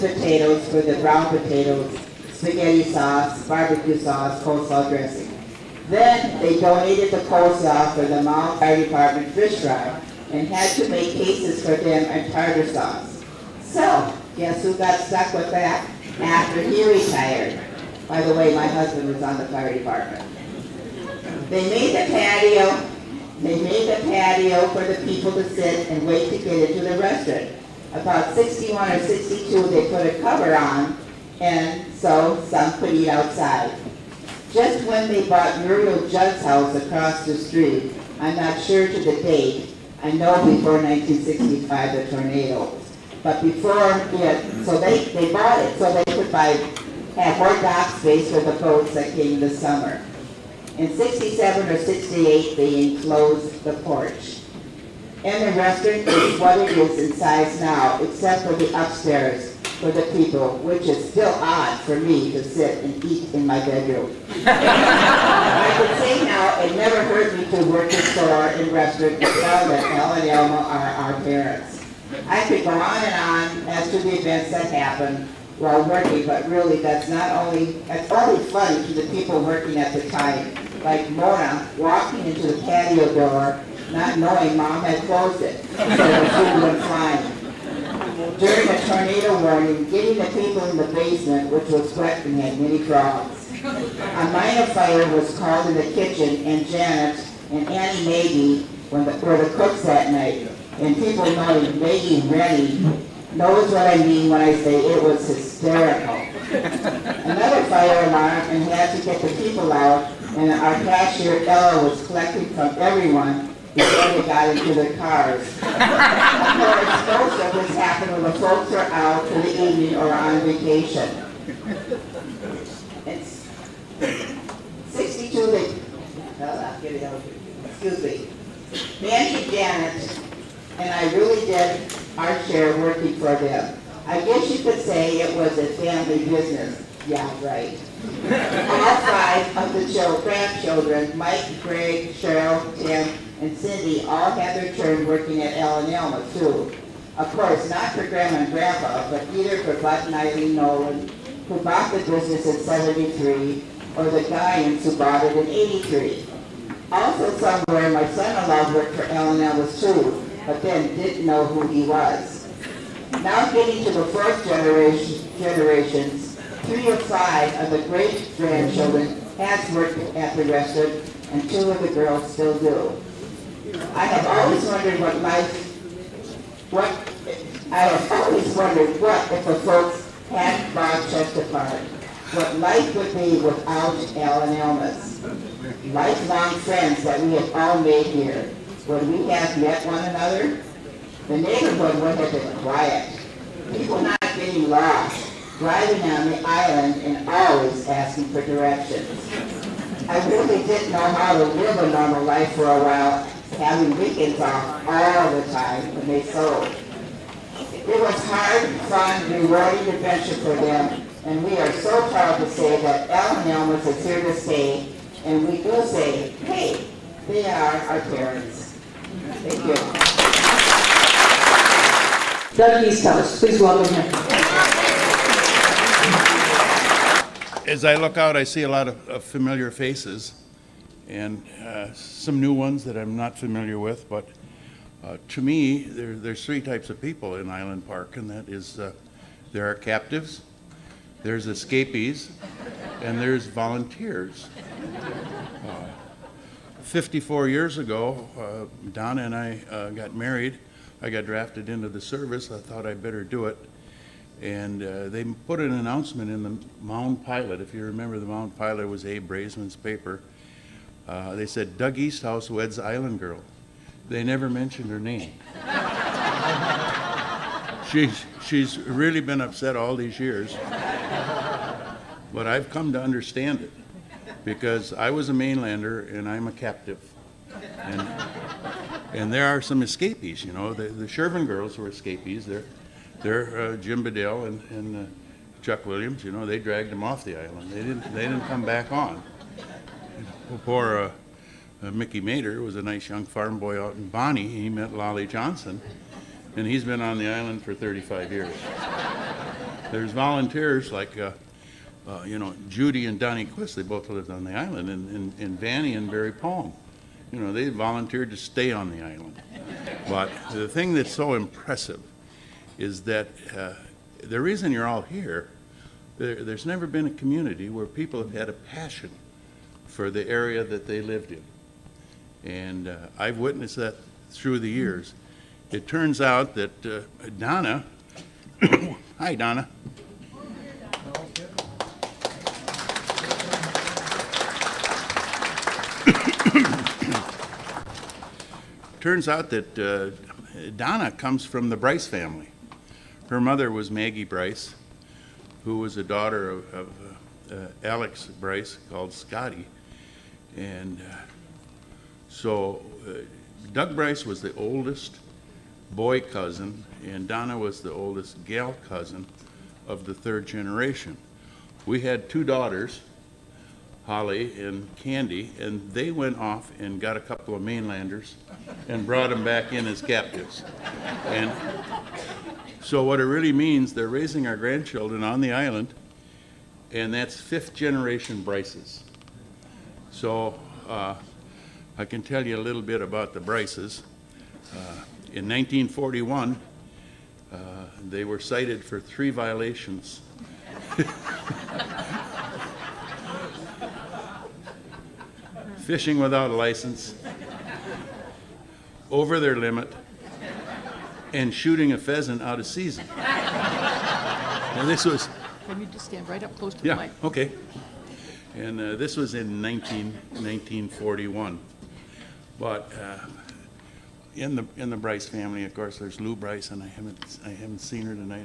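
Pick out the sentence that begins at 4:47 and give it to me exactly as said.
They didn't, they didn't come back on.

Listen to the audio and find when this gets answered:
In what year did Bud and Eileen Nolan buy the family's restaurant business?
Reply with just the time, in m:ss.
2:32.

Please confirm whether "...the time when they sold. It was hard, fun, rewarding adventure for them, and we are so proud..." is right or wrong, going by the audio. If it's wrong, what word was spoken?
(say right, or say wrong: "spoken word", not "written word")
right.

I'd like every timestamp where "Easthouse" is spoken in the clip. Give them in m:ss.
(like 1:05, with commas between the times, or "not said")
3:42, 4:21.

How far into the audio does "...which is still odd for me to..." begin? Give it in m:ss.
1:00.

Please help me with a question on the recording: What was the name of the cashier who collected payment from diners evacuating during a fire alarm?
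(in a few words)
Ella.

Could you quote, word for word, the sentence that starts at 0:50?
In 67 or 68, they enclosed the porch.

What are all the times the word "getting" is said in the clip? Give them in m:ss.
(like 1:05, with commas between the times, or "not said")
1:29, 2:43, 3:14.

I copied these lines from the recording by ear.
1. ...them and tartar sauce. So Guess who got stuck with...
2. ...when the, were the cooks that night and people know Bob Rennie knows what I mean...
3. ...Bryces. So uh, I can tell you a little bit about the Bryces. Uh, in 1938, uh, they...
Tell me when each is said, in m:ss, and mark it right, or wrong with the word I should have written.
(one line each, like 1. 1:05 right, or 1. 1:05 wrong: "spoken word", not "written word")
1. 0:11 right
2. 1:38 wrong: "Maggie", not "Bob"
3. 6:18 wrong: "1941", not "1938".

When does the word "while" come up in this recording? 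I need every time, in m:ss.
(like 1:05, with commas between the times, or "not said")
1:15, 3:22.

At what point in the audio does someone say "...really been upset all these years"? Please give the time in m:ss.
4:28.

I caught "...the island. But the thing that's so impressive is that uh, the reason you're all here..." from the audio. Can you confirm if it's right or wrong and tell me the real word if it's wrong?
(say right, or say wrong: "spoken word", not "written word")
right.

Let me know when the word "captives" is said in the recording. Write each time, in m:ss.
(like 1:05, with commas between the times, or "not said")
3:59, 4:36, 6:09.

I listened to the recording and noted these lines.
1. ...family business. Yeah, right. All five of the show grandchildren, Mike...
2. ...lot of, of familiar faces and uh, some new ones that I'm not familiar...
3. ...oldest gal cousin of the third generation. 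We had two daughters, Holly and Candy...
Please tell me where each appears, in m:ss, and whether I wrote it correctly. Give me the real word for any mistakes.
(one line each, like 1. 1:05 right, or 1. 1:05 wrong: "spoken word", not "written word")
1. 2:15 right
2. 3:48 right
3. 5:57 right.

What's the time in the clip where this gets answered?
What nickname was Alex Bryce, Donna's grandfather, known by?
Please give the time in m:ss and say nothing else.
5:49.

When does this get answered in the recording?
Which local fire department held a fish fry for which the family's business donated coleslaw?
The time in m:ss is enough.
0:08.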